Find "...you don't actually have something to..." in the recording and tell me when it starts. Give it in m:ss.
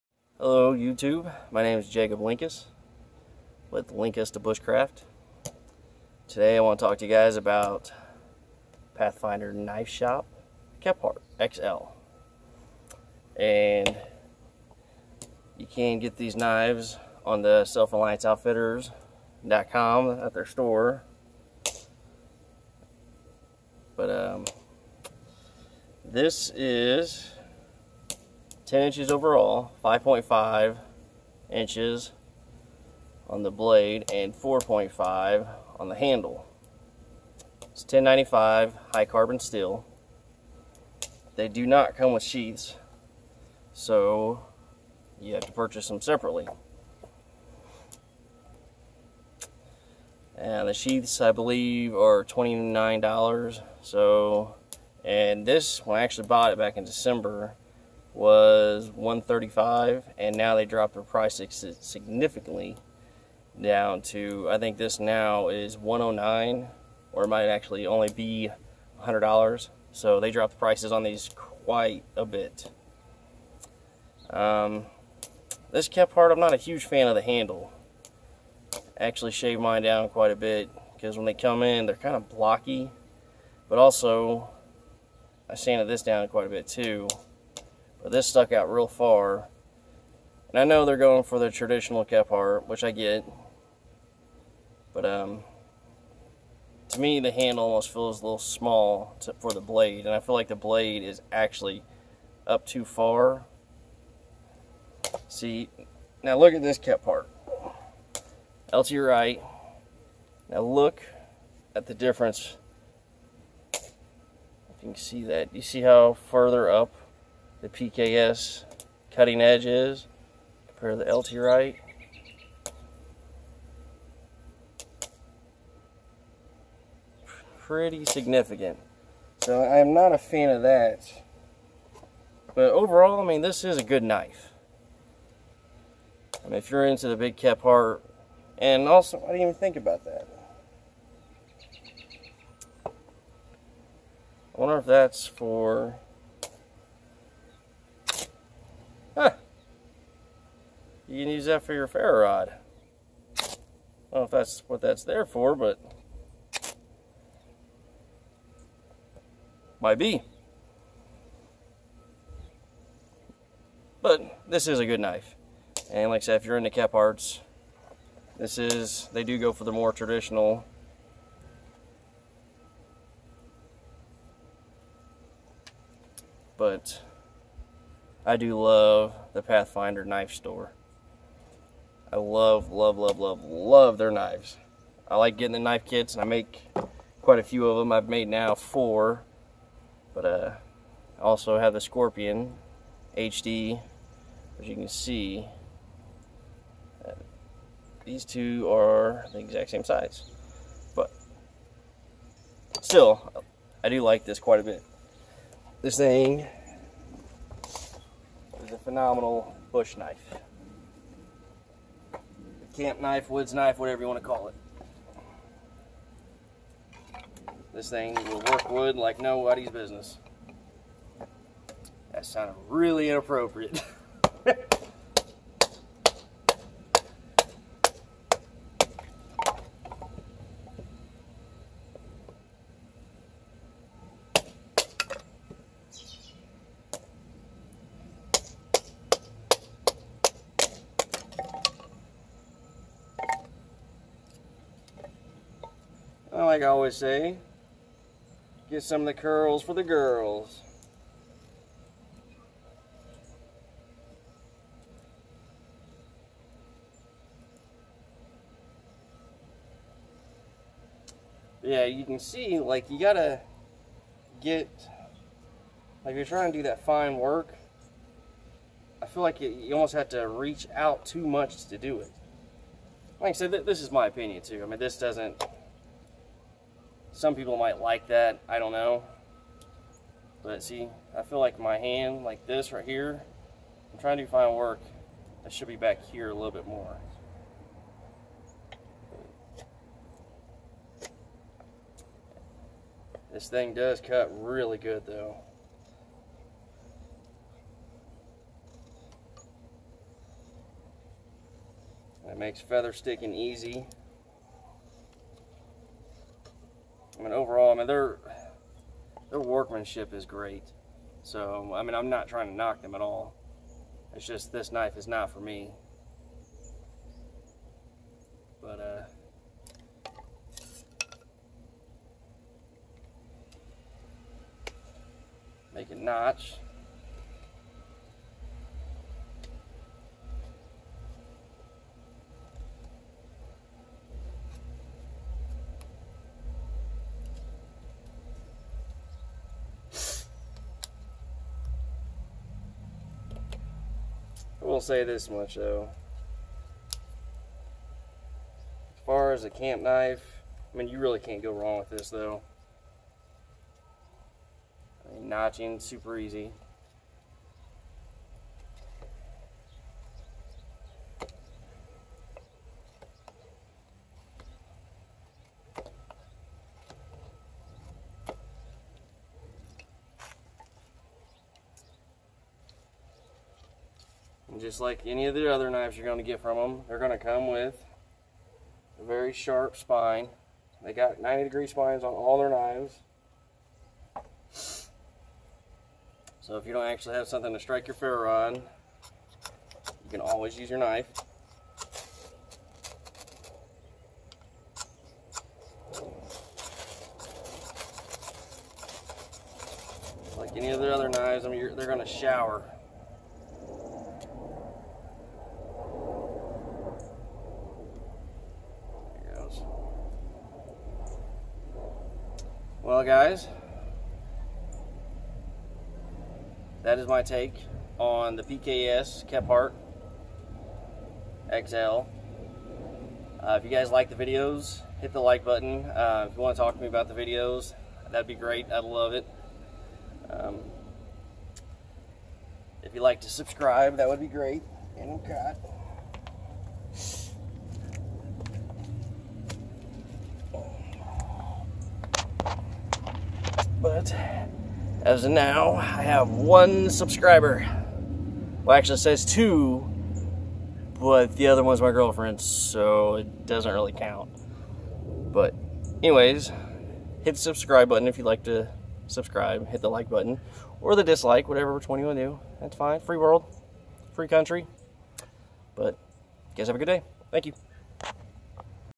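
6:26.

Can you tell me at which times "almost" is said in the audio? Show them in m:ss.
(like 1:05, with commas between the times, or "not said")
1:37, 4:29.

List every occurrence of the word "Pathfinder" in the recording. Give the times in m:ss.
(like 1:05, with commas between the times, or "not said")
0:08, 2:59.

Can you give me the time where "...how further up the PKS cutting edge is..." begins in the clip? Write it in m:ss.
1:55.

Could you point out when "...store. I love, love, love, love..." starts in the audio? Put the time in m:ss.
3:00.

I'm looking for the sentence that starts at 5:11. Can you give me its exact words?
So, I mean, I'm not trying to knock them at all.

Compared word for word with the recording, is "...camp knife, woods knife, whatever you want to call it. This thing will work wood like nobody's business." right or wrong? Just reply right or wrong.
right.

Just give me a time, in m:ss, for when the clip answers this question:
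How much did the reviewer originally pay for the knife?
0:58.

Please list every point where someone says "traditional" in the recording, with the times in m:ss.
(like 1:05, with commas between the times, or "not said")
1:31, 2:49.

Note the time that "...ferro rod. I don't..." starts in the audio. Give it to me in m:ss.
2:31.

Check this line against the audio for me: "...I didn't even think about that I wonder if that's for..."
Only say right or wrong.
right.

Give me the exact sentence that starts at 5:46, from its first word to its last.
As far as a camp knife, I mean, you really can't go wrong with this though.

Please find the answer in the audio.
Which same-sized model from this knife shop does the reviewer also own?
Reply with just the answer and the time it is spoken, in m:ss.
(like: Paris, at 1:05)
Scorpion HD, at 3:11.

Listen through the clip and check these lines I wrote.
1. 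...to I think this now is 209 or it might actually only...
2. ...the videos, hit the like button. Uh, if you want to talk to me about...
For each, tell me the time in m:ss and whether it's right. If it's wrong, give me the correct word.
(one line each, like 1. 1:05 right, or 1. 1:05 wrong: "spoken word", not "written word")
1. 1:04 wrong: "109", not "209"
2. 7:04 right.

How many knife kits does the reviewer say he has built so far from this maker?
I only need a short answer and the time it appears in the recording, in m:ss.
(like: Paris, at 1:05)
4, at 3:08.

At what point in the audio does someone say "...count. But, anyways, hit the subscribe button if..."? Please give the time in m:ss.
7:33.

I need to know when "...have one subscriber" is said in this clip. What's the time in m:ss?
7:26.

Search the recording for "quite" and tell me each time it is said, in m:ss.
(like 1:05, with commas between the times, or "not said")
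1:11, 1:20, 1:26, 3:07, 3:24.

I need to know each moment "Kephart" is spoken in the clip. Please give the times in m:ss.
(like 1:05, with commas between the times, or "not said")
0:10, 1:15, 1:32, 1:46, 2:46, 6:59.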